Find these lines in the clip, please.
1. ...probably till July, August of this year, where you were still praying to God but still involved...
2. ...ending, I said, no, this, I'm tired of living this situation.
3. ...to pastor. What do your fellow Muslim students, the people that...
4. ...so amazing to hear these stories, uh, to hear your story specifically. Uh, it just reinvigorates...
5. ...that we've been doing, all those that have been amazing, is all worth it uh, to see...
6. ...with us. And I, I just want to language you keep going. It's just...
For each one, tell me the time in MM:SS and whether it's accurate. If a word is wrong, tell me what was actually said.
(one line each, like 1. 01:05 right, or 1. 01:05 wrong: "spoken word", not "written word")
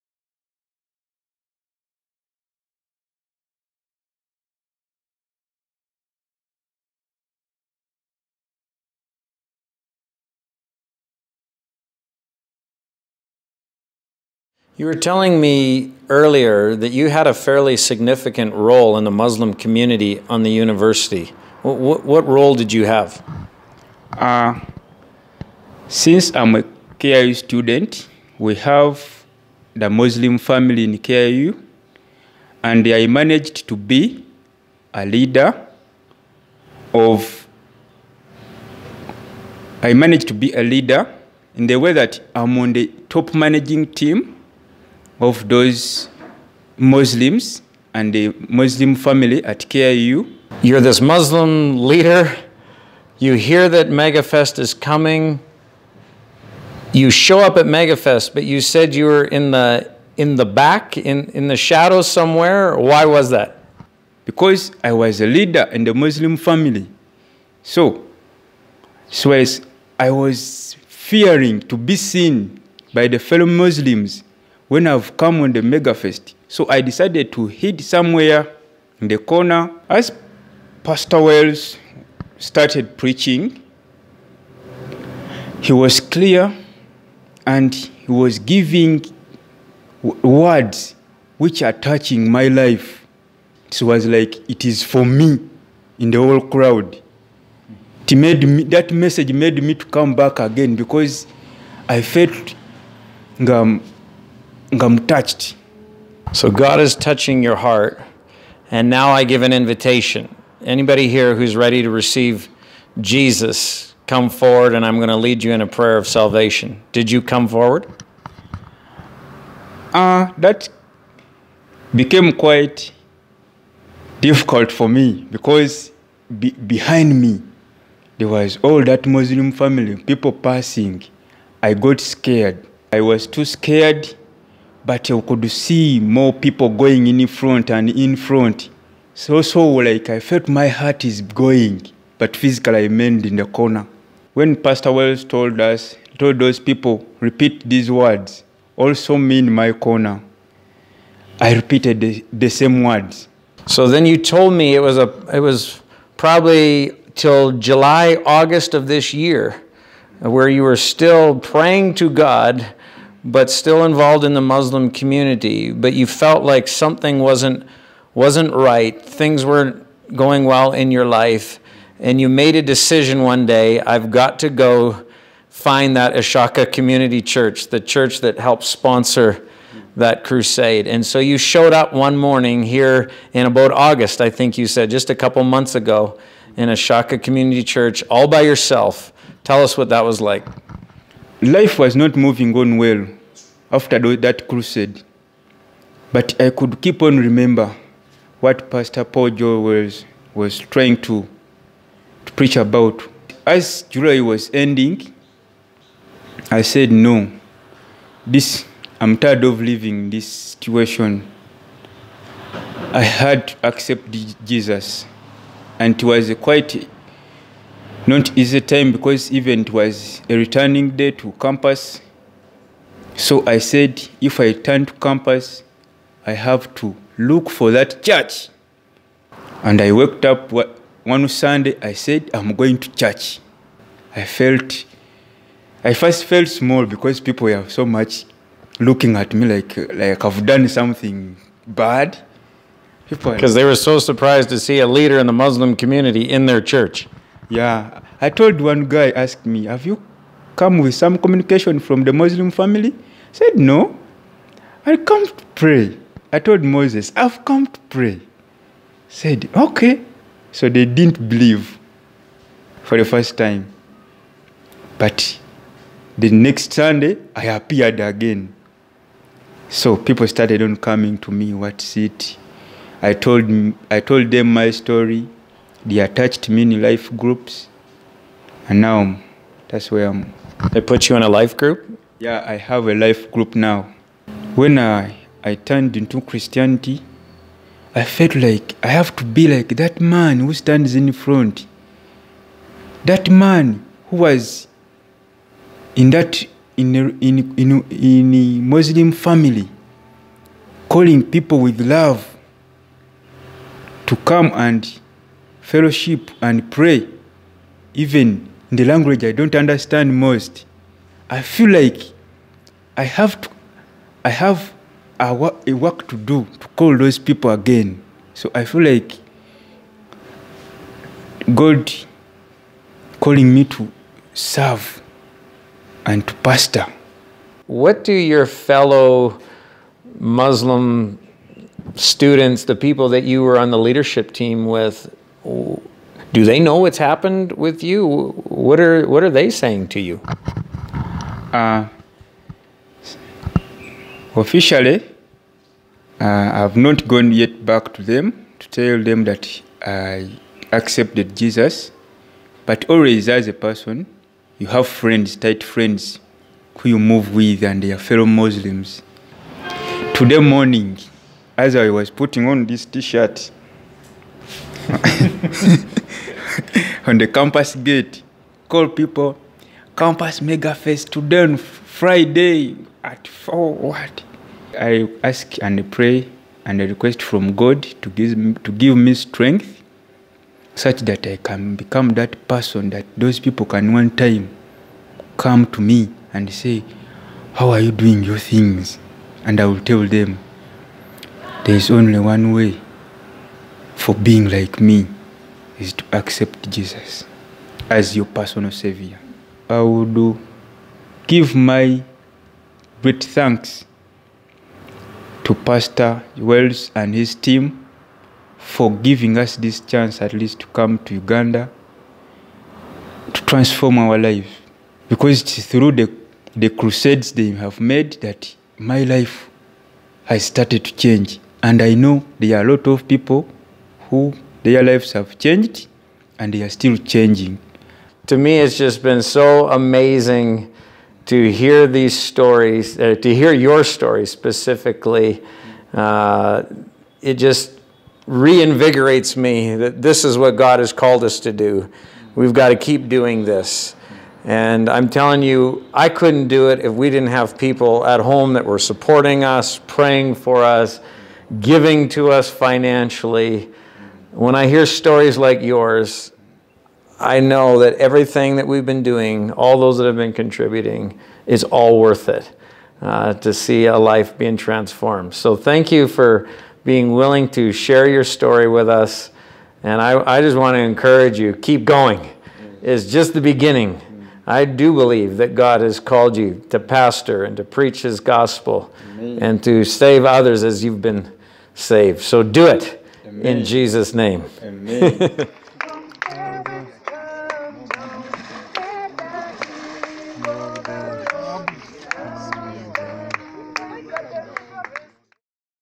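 1. 02:36 right
2. 03:24 right
3. 05:26 right
4. 07:09 right
5. 07:38 wrong: "contributing", not "amazing"
6. 07:48 wrong: "encourage", not "language".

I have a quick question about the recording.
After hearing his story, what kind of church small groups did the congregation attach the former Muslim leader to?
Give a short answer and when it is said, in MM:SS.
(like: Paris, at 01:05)
Life groups, at 04:36.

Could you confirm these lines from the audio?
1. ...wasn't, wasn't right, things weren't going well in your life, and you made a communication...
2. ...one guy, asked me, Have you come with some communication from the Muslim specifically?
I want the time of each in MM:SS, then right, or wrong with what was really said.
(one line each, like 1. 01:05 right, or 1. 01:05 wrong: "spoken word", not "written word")
1. 02:47 wrong: "decision", not "communication"
2. 04:08 wrong: "family", not "specifically".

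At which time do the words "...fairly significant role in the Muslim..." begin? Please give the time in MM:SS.
00:17.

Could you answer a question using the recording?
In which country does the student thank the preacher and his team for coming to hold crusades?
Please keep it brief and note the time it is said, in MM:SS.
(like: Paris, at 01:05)
Uganda, at 06:51.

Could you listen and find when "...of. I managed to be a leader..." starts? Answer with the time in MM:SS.
00:36.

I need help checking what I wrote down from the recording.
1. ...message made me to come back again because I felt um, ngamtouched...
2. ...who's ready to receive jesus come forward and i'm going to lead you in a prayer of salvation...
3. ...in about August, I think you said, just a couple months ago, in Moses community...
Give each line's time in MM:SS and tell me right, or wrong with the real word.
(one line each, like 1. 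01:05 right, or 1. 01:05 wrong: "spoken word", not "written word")
1. 01:38 right
2. 01:51 right
3. 03:03 wrong: "Ishaka", not "Moses".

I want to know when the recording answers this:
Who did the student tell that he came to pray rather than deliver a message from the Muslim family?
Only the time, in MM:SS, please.
04:16.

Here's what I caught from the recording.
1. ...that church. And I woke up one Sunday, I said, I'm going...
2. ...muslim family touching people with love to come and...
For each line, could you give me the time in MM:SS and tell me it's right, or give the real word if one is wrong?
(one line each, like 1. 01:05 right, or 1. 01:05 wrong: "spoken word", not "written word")
1. 03:47 right
2. 04:58 wrong: "calling", not "touching".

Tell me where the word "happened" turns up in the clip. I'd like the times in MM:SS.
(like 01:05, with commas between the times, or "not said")
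05:36.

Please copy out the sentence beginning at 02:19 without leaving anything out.
So, so like I felt my heart is going, but physically I remained in the corner.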